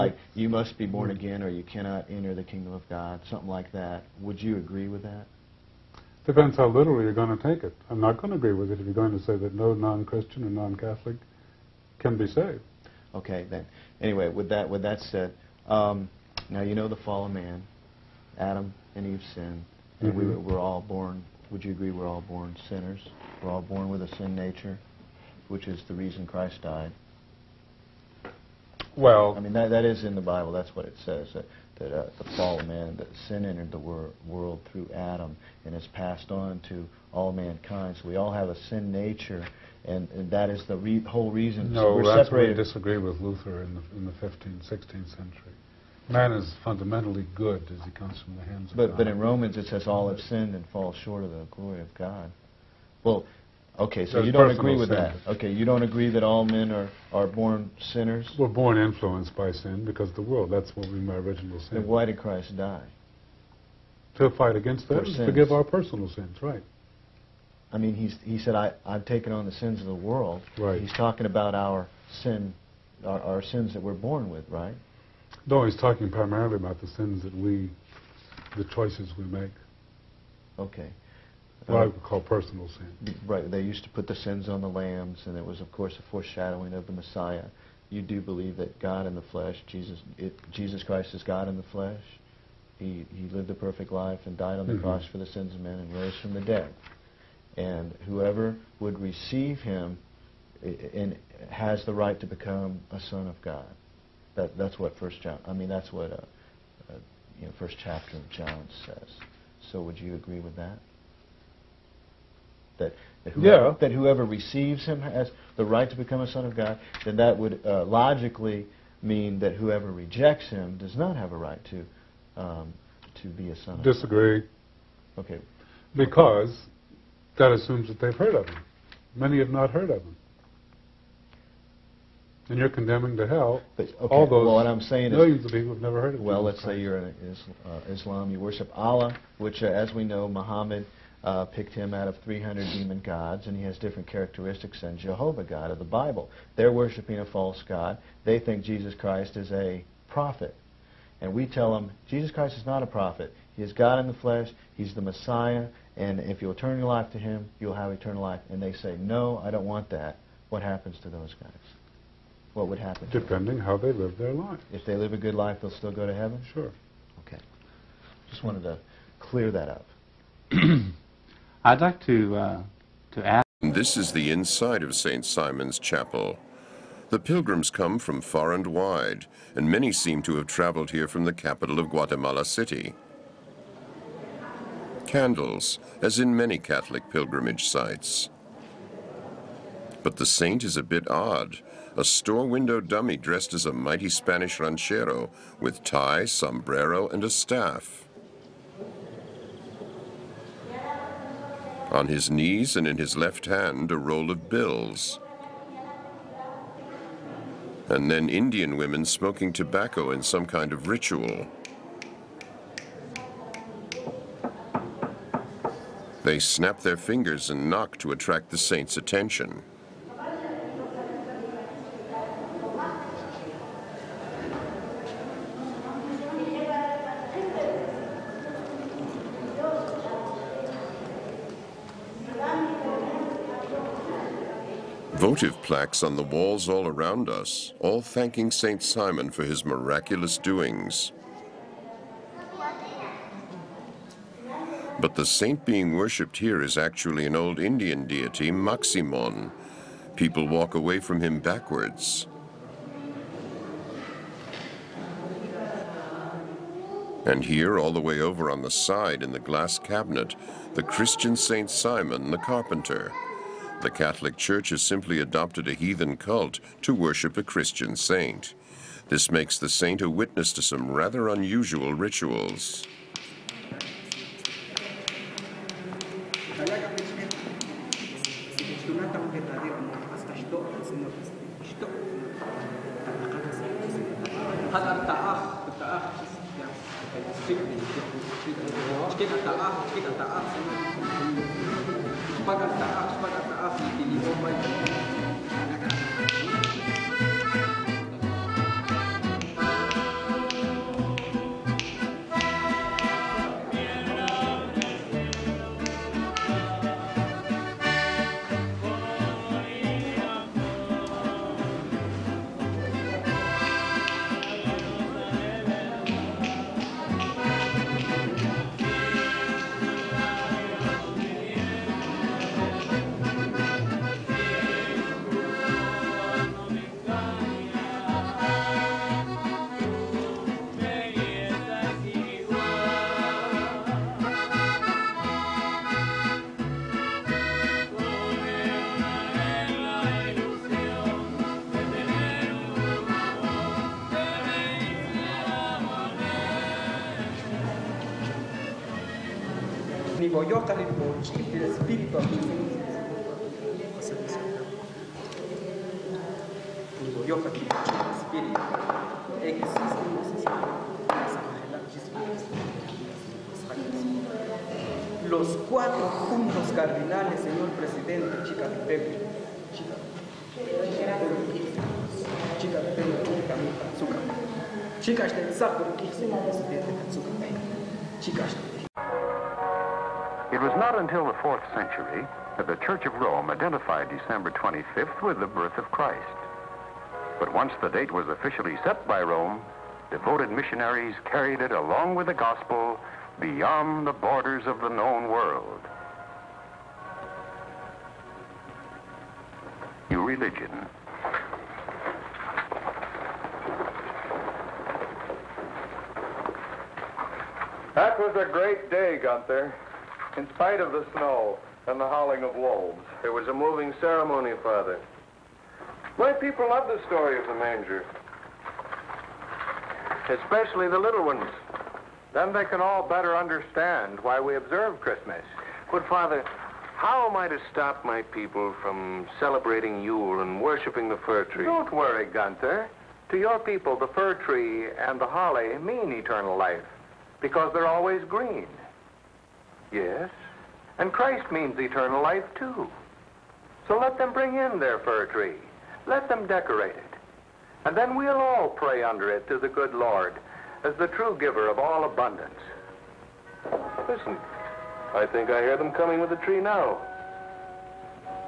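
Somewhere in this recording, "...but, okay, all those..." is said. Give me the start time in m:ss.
2:13.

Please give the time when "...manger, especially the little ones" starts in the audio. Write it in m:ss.
6:57.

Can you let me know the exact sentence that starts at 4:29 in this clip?
This makes the saint a witness to some rather unusual rituals.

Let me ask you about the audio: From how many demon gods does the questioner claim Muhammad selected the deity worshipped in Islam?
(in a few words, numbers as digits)
300.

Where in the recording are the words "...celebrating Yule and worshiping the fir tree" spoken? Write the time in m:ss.
7:09.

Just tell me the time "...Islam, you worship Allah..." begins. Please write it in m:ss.
2:17.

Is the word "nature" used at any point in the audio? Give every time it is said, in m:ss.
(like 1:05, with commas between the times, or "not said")
0:24, 0:38.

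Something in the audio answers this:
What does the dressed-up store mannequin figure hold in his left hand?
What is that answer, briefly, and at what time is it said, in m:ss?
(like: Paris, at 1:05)
a roll of bills, at 3:23.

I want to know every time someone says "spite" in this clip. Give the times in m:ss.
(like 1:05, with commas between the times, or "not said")
6:50.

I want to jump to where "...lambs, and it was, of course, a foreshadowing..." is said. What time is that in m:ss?
1:24.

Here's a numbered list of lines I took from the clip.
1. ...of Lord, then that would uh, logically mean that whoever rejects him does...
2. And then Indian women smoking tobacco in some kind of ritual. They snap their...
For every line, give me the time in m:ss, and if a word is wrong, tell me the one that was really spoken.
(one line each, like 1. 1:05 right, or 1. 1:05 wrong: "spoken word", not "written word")
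1. 1:56 wrong: "God", not "Lord"
2. 3:27 right.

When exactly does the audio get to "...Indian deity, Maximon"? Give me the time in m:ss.
4:07.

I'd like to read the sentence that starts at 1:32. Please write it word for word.
He, he lived a perfect life and died on the mm -hmm.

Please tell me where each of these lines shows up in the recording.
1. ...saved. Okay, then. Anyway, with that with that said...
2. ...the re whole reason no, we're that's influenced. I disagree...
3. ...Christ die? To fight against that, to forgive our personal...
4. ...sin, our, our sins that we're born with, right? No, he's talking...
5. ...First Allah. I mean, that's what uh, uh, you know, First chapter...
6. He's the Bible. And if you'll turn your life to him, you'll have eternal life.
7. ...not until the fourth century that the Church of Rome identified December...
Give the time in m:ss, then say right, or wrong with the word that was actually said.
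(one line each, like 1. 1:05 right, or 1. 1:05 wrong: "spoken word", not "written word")
1. 0:12 right
2. 0:40 wrong: "separated", not "influenced"
3. 1:02 right
4. 1:12 right
5. 1:44 wrong: "John", not "Allah"
6. 2:34 wrong: "Messiah", not "Bible"
7. 6:20 right.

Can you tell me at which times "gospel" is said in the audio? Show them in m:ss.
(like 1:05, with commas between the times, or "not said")
6:32.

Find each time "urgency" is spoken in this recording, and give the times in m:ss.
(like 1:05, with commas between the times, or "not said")
not said.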